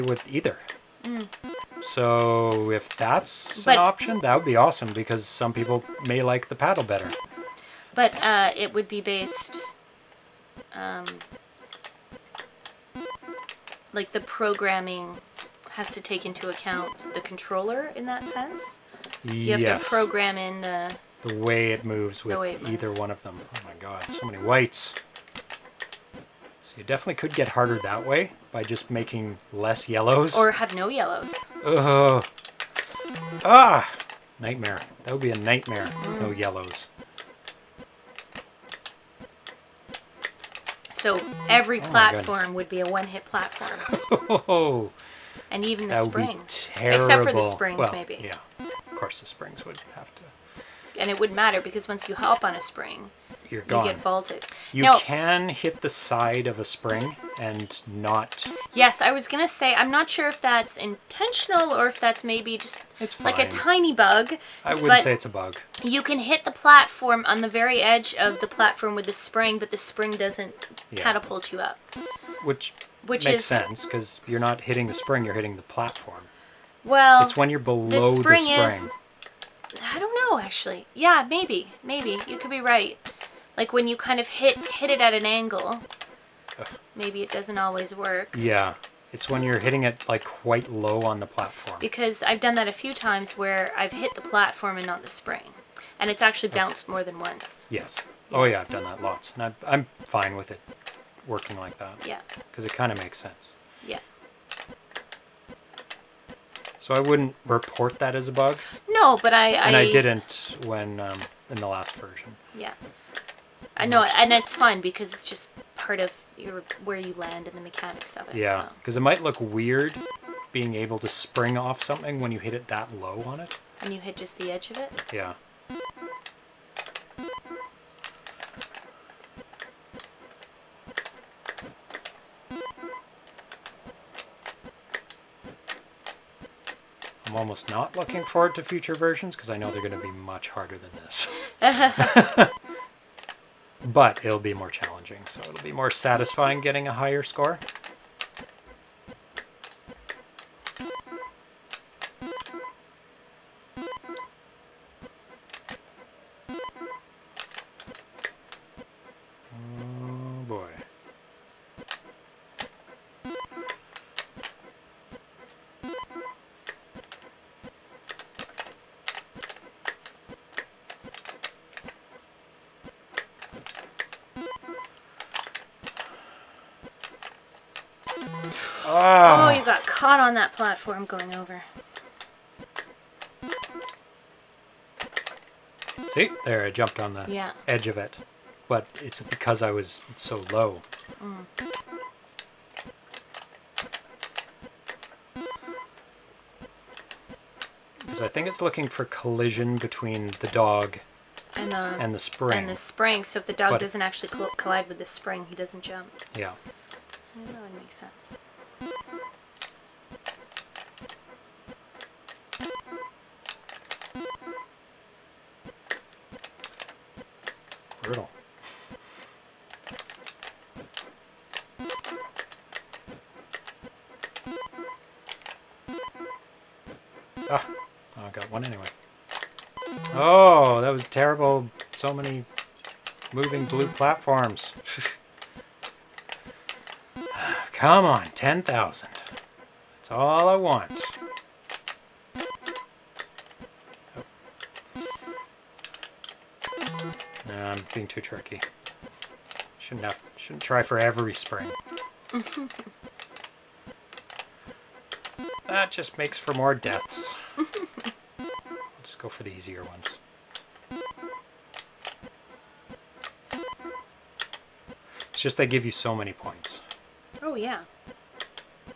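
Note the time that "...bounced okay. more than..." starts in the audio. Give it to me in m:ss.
1:36.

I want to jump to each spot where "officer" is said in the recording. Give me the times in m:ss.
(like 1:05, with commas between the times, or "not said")
not said.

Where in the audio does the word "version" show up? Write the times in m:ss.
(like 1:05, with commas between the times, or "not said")
1:51, 2:18.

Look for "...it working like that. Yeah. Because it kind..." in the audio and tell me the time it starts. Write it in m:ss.
1:40.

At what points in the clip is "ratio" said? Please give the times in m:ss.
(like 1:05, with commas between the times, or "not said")
not said.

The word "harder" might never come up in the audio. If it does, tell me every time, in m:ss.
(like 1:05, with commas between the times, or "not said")
0:27, 2:20.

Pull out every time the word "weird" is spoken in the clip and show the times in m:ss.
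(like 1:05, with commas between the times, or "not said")
1:59.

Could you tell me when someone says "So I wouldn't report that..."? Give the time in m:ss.
1:46.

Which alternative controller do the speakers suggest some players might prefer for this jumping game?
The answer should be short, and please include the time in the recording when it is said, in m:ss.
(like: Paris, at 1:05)
paddle, at 0:06.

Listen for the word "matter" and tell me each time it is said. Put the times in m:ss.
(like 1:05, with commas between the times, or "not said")
0:51.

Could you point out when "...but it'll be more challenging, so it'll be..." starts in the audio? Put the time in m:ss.
2:23.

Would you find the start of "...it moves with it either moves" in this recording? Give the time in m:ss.
0:21.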